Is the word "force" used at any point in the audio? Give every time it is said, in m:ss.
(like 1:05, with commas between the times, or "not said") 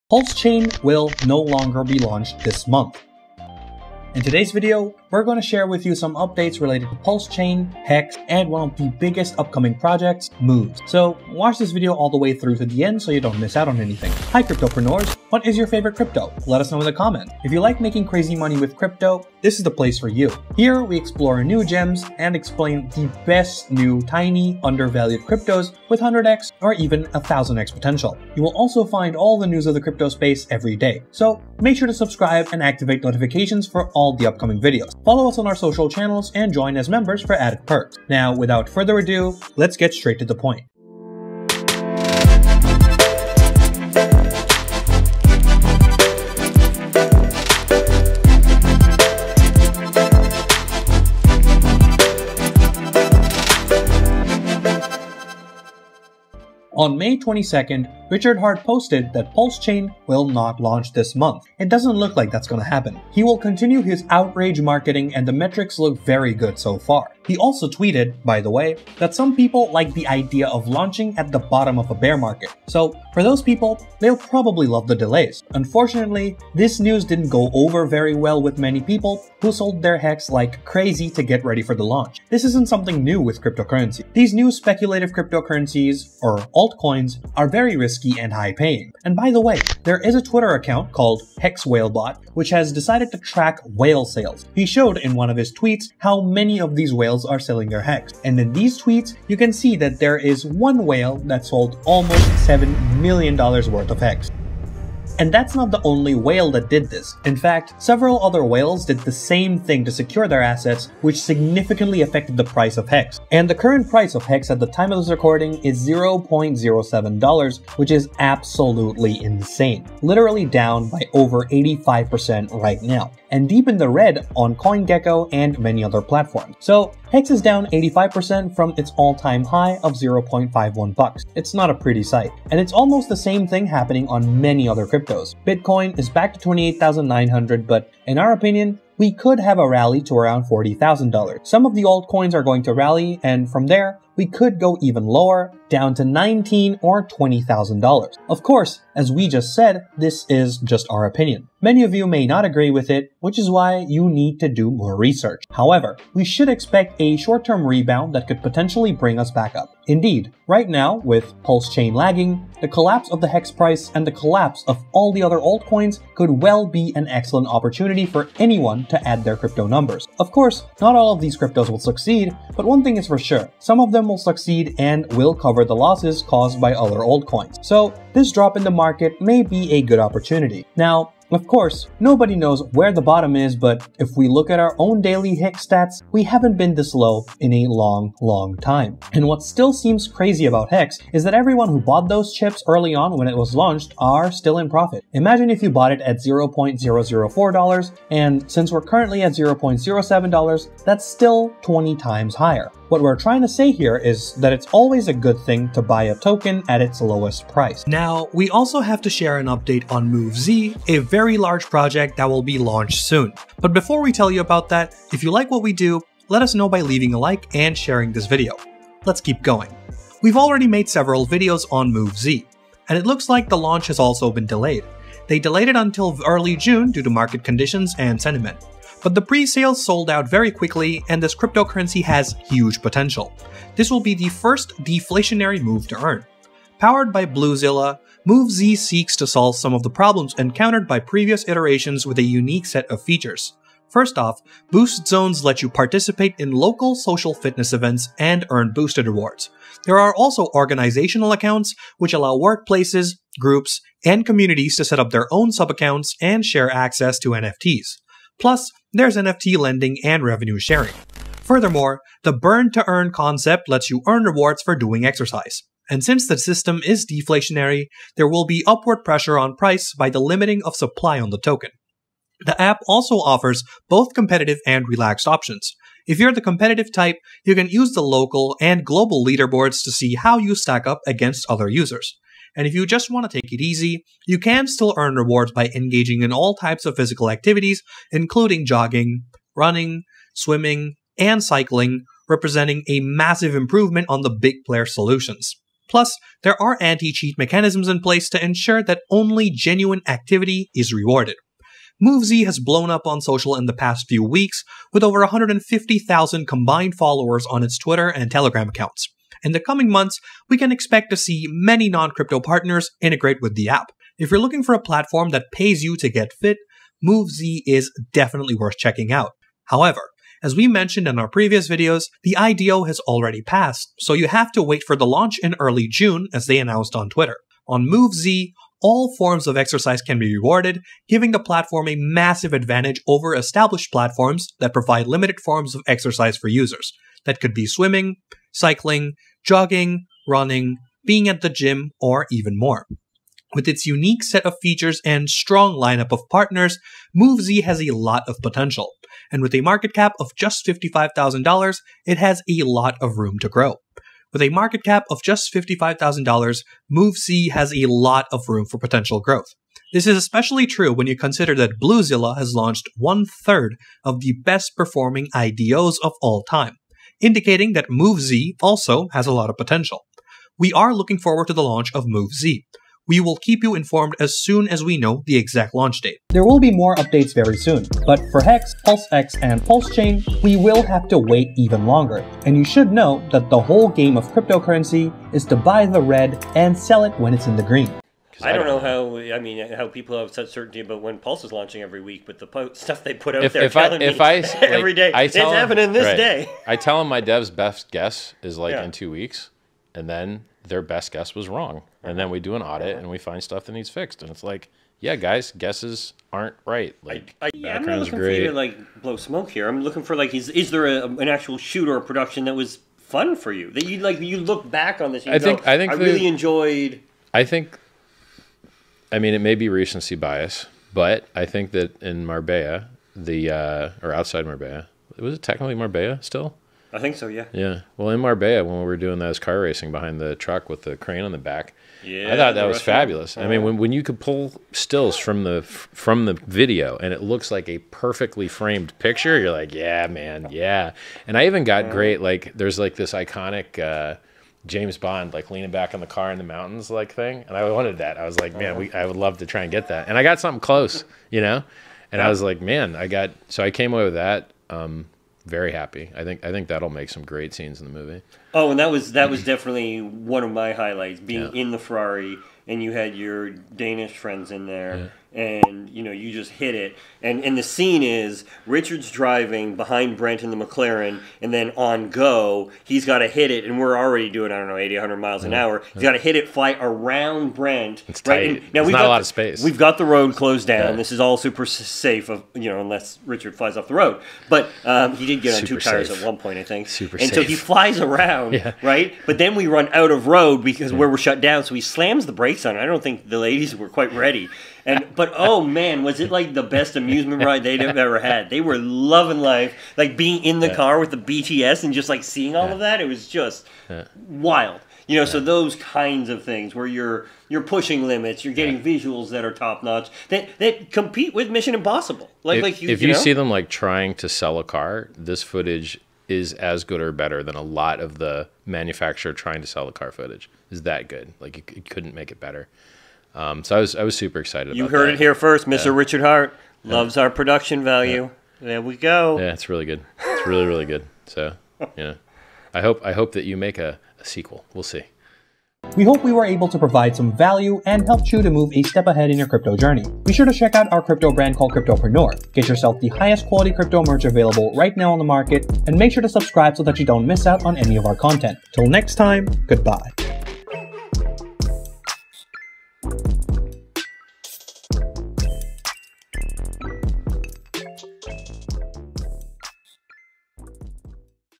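not said.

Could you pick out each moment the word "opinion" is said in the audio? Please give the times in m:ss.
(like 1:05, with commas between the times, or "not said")
2:18, 2:31.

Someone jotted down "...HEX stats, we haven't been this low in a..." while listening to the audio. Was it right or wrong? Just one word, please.
right.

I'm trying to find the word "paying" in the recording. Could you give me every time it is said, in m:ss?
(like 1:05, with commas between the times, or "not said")
1:28.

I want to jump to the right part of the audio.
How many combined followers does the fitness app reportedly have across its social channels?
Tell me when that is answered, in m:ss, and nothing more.
5:05.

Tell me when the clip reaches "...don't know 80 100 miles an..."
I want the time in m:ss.
7:54.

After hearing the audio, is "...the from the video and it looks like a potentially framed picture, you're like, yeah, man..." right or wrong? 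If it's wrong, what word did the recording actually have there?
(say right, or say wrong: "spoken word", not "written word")
wrong: "perfectly", not "potentially".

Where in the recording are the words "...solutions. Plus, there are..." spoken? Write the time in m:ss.
4:54.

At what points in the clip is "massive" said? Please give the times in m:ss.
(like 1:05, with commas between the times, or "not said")
4:53, 5:31.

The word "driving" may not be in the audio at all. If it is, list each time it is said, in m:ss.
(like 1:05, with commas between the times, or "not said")
7:49.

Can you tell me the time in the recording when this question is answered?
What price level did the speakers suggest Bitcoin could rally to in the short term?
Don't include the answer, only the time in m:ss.
2:20.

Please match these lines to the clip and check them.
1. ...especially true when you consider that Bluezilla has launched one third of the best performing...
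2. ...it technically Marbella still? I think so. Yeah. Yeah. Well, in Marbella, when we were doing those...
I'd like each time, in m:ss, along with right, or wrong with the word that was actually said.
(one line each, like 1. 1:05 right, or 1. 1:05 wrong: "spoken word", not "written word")
1. 6:00 right
2. 7:05 right.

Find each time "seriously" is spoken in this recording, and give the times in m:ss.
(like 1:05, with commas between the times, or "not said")
not said.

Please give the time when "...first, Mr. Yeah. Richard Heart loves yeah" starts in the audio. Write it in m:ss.
8:45.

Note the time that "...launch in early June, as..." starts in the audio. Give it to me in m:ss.
5:25.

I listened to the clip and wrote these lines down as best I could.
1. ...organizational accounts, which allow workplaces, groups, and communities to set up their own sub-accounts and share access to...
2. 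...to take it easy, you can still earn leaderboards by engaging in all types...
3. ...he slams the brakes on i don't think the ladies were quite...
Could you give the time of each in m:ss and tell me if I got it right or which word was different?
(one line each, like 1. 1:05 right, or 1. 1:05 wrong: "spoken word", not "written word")
1. 4:10 right
2. 4:43 wrong: "rewards", not "leaderboards"
3. 8:11 right.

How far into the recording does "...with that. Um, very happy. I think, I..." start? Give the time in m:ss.
7:34.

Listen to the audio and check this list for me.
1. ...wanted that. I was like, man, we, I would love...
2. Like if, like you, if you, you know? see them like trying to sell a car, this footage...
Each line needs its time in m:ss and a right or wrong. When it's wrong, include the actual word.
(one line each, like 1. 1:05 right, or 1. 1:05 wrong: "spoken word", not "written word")
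1. 7:27 right
2. 8:32 right.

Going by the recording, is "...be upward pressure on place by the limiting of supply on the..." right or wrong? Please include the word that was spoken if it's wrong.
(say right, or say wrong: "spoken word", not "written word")
wrong: "price", not "place".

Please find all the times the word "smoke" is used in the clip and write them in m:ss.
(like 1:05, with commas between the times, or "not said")
6:49.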